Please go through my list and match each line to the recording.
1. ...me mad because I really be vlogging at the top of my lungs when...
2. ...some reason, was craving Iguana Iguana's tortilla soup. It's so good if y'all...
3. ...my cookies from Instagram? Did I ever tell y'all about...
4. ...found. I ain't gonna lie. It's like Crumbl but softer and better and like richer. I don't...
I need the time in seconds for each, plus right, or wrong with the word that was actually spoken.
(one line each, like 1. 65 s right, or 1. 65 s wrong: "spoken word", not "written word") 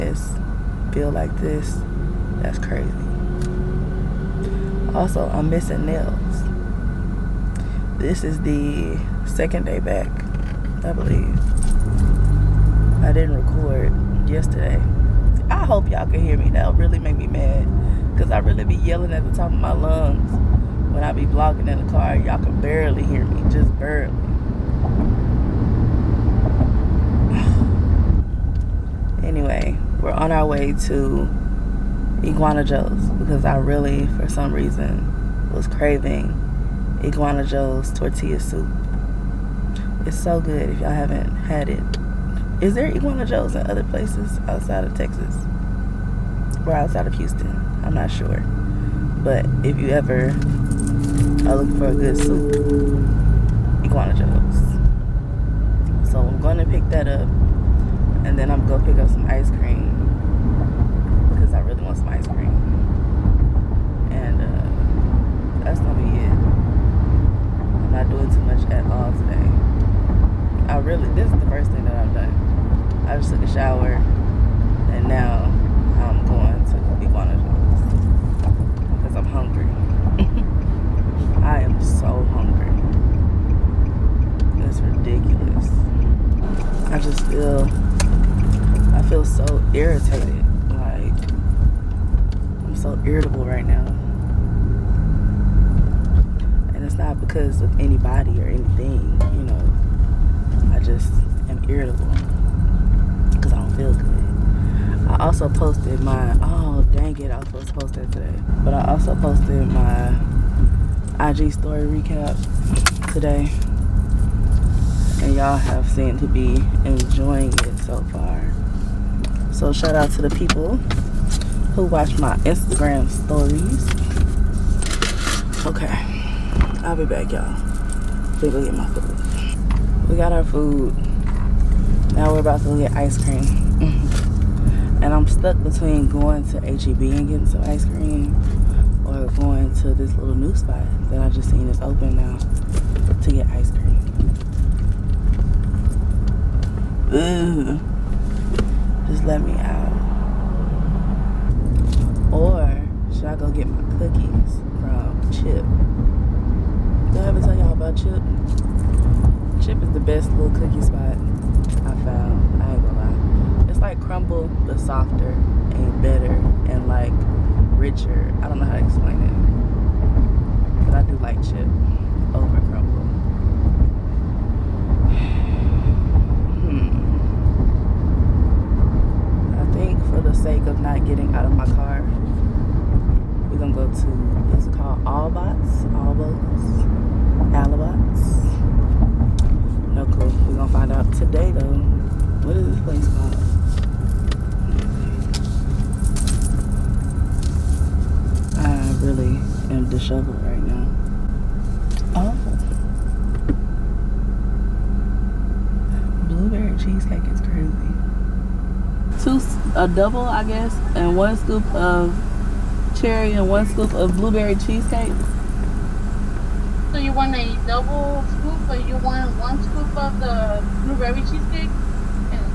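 1. 17 s wrong: "yelling", not "vlogging"
2. 34 s wrong: "Joe", not "Iguana"
3. 153 s wrong: "Chip", not "Instagram"
4. 162 s right.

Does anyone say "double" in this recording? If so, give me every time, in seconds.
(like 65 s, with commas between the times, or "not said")
209 s, 217 s.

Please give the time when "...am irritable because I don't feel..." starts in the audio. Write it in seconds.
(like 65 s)
101 s.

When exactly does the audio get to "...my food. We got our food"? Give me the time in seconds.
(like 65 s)
128 s.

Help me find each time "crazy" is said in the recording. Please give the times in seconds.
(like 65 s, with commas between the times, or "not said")
2 s, 207 s.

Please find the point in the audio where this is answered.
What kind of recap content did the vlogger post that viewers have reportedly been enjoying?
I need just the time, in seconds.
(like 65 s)
111 s.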